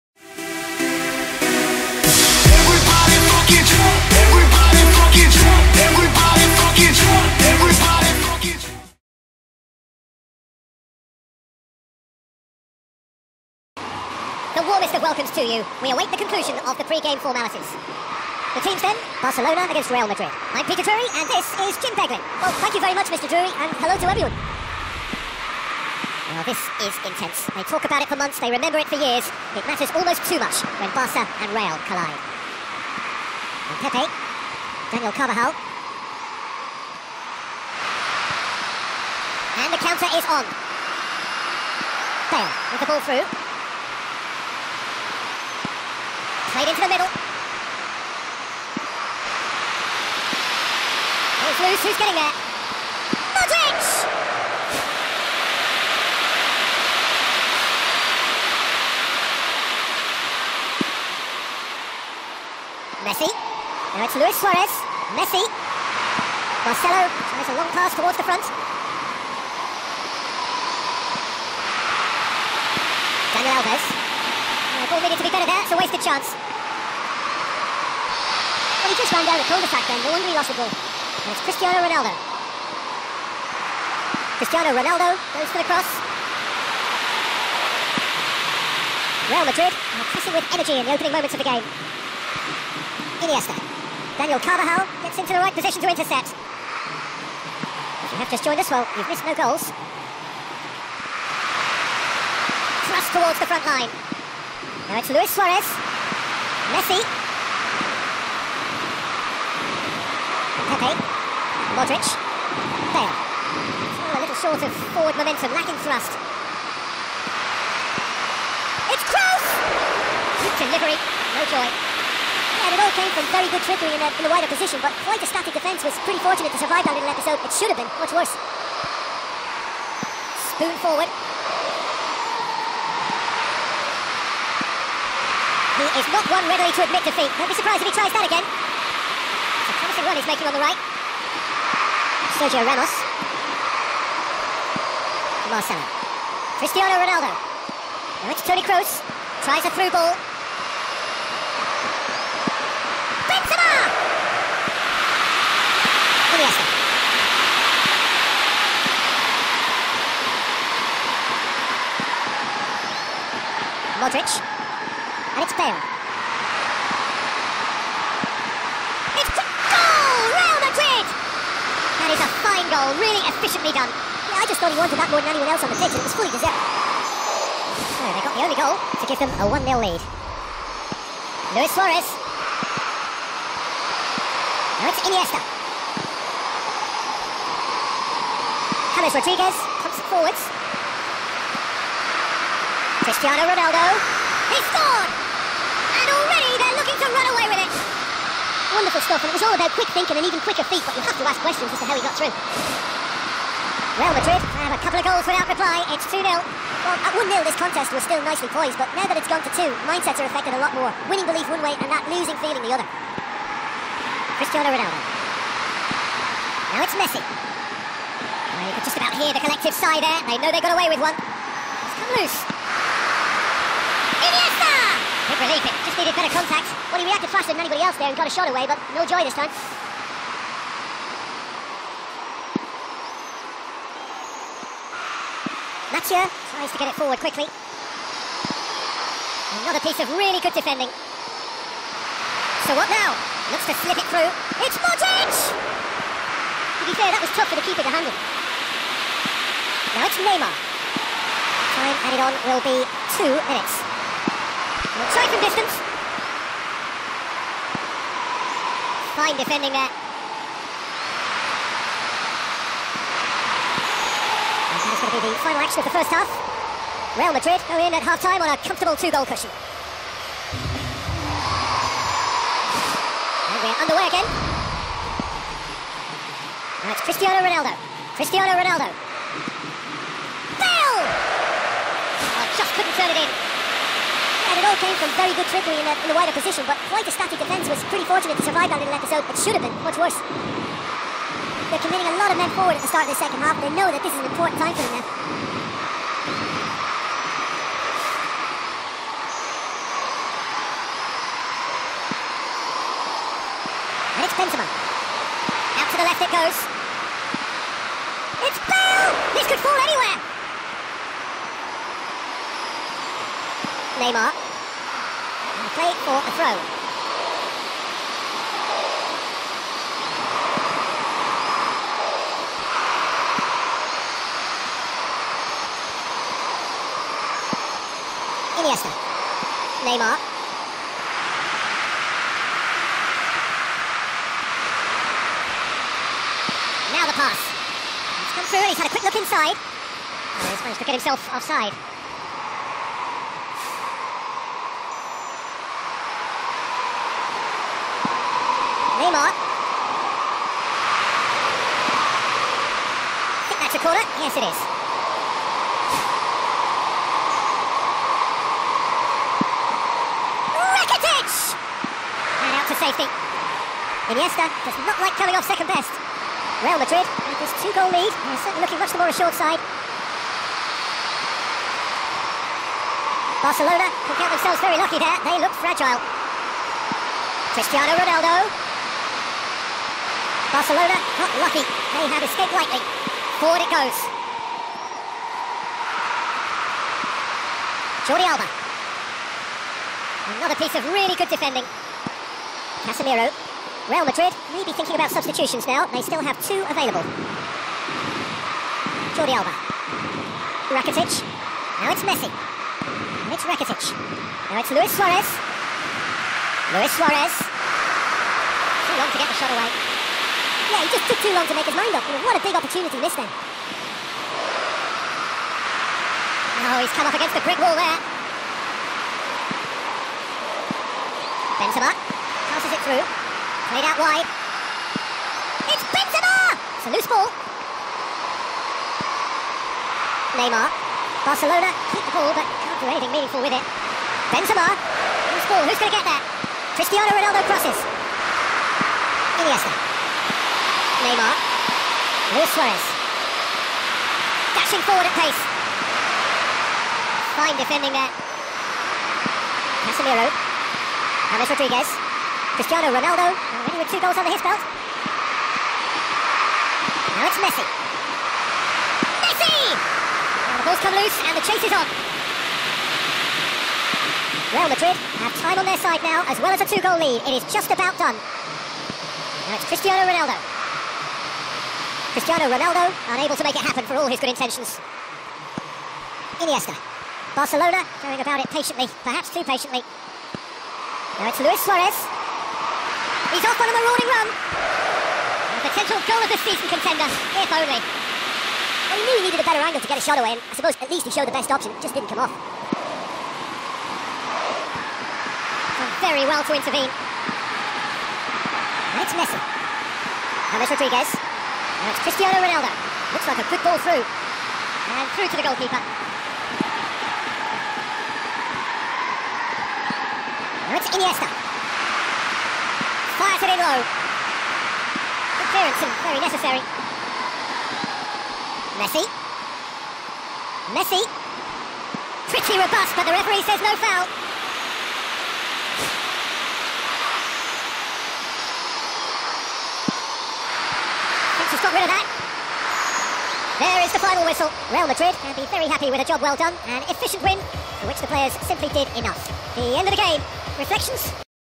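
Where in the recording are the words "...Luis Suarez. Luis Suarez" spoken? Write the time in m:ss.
6:44.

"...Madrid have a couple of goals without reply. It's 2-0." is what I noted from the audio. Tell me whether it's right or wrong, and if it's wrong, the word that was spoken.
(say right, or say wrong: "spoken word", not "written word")
right.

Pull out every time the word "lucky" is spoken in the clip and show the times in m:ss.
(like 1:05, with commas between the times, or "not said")
6:14, 6:21.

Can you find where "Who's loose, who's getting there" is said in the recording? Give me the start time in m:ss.
0:51.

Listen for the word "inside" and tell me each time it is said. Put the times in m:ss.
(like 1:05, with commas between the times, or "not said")
5:39.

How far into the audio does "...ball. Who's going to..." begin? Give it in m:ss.
7:15.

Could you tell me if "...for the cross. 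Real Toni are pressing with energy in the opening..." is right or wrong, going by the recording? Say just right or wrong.
wrong.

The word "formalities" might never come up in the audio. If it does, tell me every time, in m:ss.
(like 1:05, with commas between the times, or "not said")
0:17.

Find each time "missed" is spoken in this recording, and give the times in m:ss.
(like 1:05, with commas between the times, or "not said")
1:39, 6:53.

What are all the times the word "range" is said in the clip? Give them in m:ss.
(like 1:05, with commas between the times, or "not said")
not said.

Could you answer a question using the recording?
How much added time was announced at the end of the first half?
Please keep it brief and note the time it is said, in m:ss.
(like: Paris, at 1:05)
2 minutes, at 4:13.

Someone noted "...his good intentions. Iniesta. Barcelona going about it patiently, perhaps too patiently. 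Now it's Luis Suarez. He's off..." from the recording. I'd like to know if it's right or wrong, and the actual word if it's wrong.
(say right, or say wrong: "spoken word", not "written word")
right.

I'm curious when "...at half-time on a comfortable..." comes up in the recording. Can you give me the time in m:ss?
4:27.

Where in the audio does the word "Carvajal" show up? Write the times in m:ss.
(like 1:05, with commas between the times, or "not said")
0:35, 1:34.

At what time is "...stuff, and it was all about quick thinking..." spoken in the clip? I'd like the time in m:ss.
3:19.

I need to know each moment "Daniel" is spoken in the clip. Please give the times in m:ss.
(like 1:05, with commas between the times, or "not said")
0:34, 1:13, 1:34.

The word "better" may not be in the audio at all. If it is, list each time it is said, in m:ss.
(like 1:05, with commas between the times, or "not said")
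1:15, 3:46, 8:09.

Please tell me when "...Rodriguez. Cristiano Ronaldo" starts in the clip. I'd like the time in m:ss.
7:31.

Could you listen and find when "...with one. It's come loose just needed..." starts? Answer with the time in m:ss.
3:40.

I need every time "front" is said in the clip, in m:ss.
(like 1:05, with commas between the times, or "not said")
1:08, 1:43.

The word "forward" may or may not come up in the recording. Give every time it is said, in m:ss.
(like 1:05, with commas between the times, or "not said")
1:54, 2:10, 3:10, 3:56, 4:52, 6:23, 7:24.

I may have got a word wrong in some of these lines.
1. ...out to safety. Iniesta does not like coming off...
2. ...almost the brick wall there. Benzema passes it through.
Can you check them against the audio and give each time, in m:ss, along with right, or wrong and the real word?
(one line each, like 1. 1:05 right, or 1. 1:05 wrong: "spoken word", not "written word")
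1. 6:02 right
2. 6:57 wrong: "against", not "almost".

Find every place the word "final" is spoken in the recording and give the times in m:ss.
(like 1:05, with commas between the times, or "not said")
4:25, 8:54.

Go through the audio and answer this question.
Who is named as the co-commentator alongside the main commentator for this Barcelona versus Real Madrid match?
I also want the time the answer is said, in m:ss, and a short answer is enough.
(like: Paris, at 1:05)
Jim Beglin, at 0:21.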